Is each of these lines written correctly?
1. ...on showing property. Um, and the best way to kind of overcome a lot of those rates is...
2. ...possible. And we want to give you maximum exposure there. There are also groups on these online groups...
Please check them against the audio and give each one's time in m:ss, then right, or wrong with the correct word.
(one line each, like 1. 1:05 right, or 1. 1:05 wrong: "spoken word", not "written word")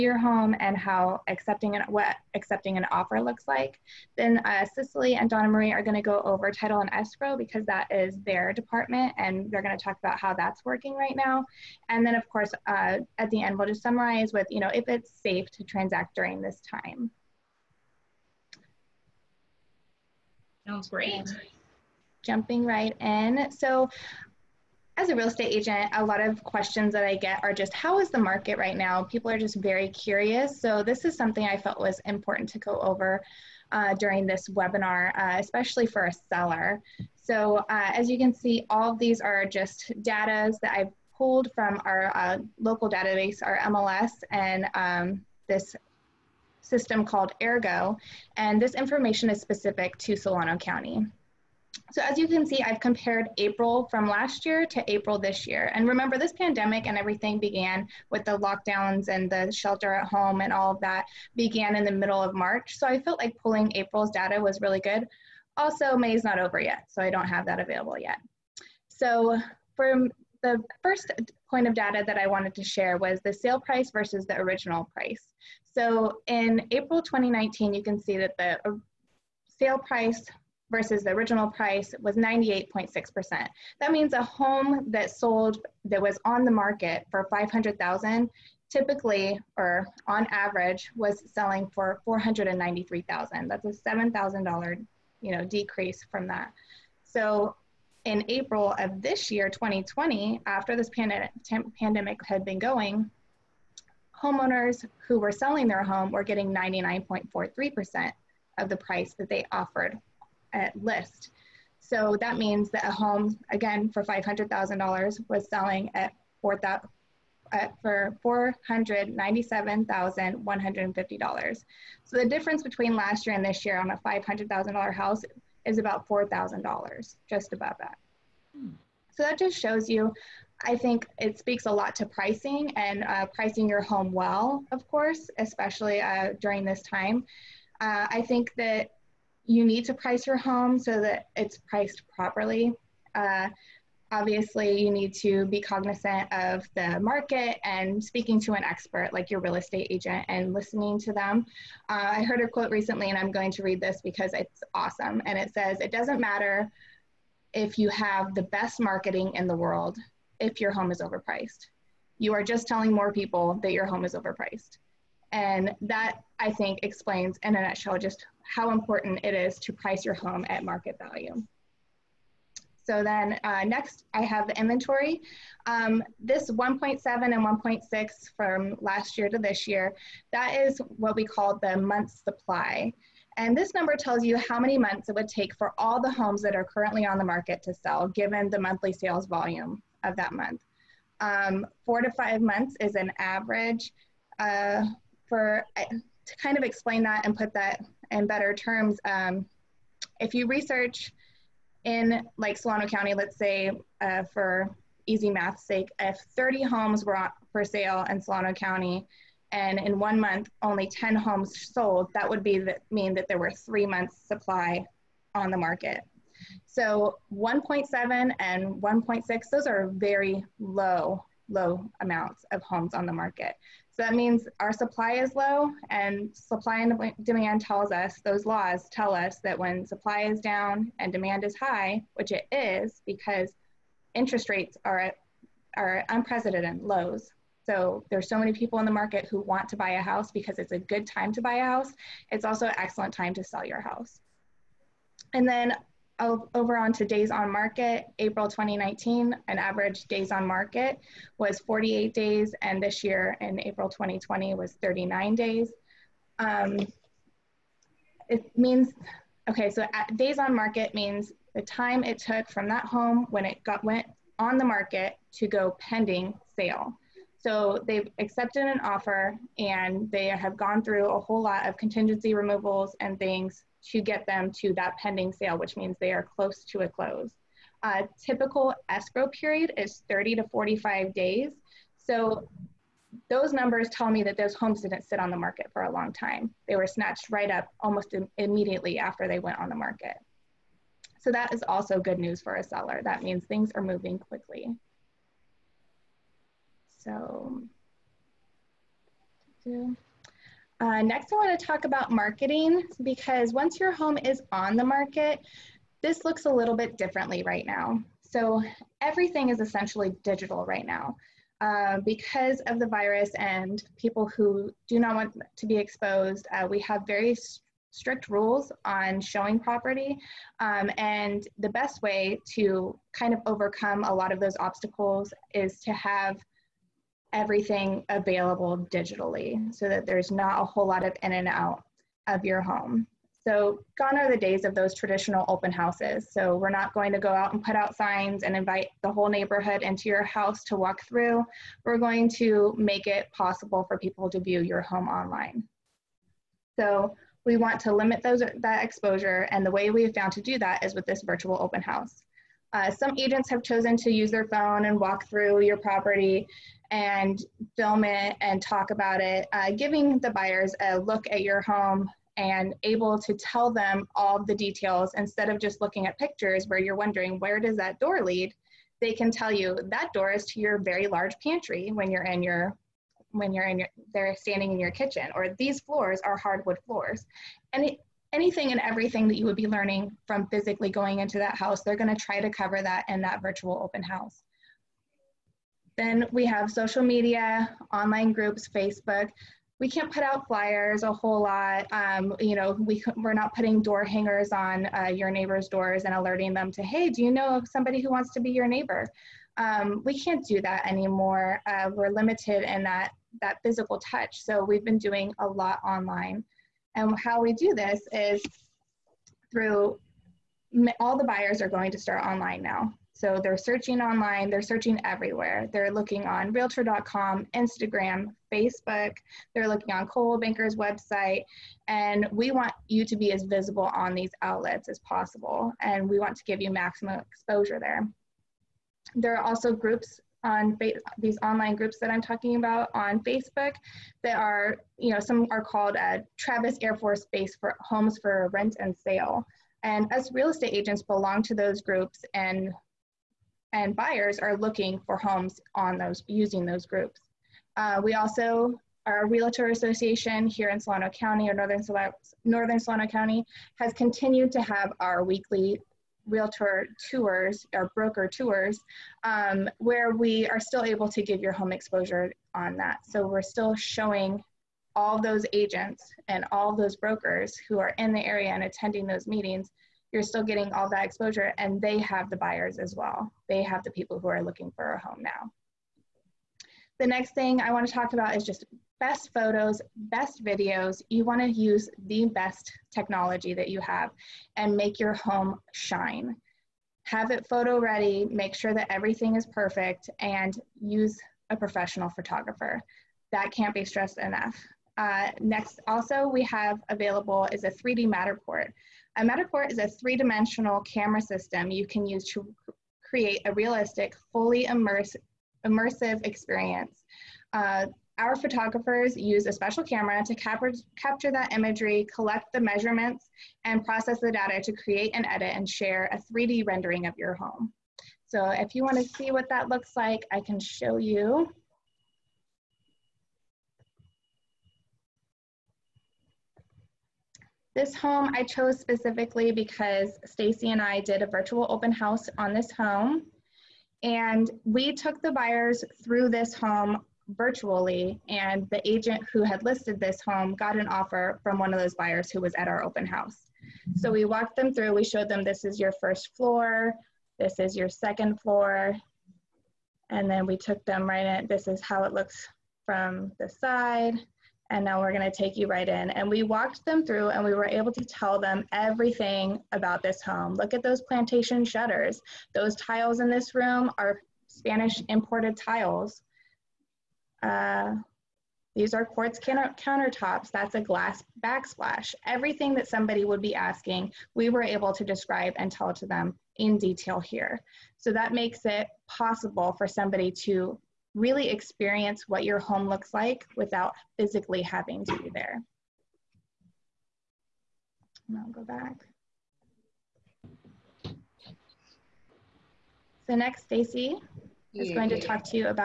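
1. 5:18 wrong: "obstacles", not "rates"
2. 7:04 right.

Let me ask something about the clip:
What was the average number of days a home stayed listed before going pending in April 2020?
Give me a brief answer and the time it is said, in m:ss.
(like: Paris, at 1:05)
39 days, at 4:14.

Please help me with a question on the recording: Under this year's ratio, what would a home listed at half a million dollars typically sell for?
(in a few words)
$497,150.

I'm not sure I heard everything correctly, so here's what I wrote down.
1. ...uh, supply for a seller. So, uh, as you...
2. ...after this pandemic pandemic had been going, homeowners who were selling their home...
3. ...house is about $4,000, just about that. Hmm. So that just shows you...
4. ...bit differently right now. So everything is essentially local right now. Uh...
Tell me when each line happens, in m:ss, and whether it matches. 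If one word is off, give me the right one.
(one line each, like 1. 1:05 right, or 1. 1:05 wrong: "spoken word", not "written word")
1. 0:35 wrong: "especially", not "supply"
2. 1:40 right
3. 2:04 right
4. 5:06 wrong: "digital", not "local".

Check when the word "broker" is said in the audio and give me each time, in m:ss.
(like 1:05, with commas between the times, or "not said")
7:37, 7:46.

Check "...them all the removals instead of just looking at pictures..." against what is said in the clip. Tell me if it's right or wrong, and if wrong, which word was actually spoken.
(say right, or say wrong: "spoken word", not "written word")
wrong: "details", not "removals".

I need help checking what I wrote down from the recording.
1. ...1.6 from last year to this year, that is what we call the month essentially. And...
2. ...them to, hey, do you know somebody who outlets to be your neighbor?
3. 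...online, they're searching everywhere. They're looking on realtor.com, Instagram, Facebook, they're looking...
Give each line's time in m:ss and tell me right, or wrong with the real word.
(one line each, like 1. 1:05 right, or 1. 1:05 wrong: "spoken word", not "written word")
1. 2:57 wrong: "supply", not "essentially"
2. 6:36 wrong: "wants", not "outlets"
3. 6:54 right.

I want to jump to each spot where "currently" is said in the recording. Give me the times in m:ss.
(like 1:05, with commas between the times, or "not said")
3:06.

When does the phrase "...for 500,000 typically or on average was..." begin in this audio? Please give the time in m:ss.
1:27.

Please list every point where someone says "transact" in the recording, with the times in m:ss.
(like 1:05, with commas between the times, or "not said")
0:15.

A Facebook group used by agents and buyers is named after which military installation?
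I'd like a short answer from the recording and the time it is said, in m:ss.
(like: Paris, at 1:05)
Travis Air Force Base, at 7:16.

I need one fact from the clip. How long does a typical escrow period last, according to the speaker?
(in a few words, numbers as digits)
30 to 45 days.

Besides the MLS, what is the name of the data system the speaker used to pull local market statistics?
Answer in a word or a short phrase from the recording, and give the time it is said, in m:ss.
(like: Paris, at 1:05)
Ergo, at 0:47.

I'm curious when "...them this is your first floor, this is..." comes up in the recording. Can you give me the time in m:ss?
9:05.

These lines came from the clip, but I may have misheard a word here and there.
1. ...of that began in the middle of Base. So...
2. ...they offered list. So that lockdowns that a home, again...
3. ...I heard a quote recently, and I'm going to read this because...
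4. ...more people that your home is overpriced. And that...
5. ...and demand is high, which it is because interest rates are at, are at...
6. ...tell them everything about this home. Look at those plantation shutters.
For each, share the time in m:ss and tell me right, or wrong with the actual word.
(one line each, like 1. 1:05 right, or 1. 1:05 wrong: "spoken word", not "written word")
1. 1:00 wrong: "March", not "Base"
2. 1:49 wrong: "means", not "lockdowns"
3. 2:32 right
4. 2:42 right
5. 3:50 right
6. 9:18 right.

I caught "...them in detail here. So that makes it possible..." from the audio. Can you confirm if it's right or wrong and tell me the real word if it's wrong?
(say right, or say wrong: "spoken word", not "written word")
right.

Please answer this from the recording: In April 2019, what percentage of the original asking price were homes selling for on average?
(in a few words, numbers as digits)
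98.6%.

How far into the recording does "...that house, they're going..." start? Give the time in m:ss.
6:21.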